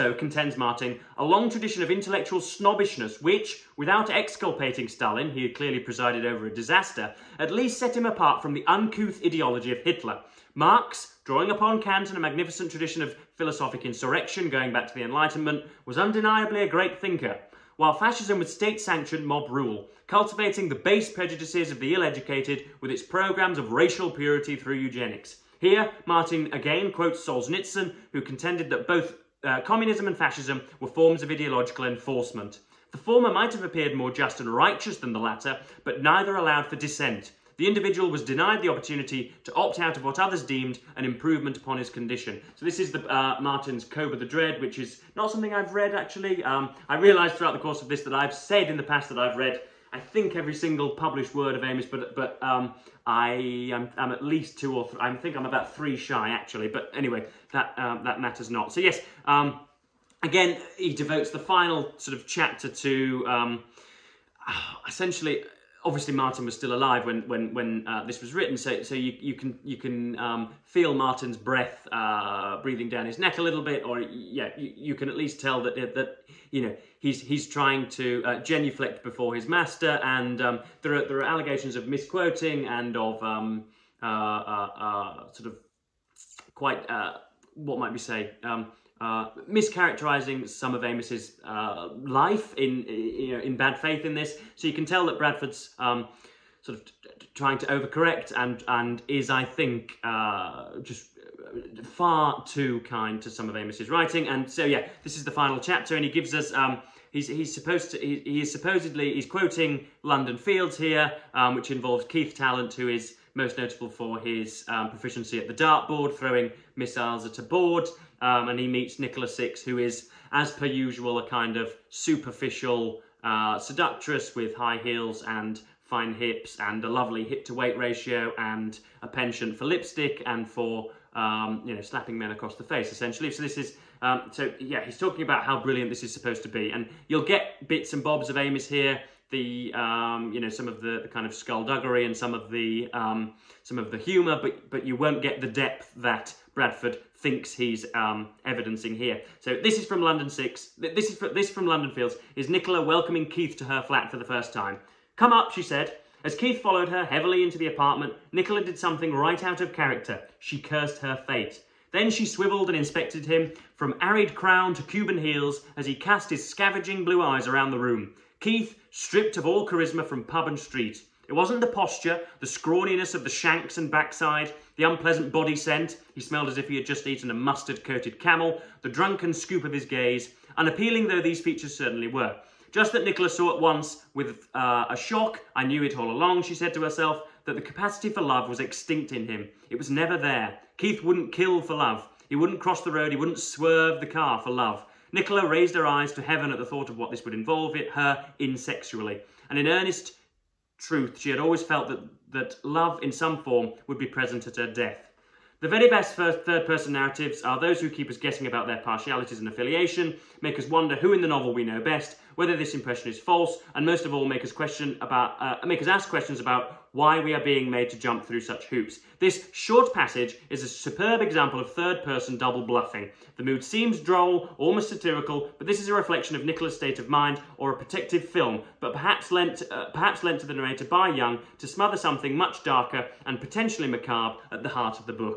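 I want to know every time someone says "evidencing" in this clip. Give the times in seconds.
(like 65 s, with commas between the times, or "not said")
148 s.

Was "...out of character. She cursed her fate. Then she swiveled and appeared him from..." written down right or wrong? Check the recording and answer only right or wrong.
wrong.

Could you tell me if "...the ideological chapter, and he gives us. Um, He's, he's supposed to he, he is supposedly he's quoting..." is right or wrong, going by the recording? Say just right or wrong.
wrong.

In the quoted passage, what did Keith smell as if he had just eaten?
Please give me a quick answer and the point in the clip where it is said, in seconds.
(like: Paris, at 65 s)
a mustard coated camel, at 177 s.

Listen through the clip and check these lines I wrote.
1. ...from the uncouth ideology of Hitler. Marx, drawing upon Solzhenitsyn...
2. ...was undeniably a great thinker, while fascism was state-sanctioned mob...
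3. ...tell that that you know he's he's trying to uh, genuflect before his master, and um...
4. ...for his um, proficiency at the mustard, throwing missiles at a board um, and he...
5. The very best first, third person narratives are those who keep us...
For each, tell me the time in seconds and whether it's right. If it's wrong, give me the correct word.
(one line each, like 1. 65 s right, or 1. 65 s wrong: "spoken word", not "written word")
1. 8 s wrong: "Kant", not "Solzhenitsyn"
2. 15 s right
3. 75 s right
4. 113 s wrong: "dartboard", not "mustard"
5. 205 s right.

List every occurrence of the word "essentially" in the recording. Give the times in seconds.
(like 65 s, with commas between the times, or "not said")
64 s, 132 s.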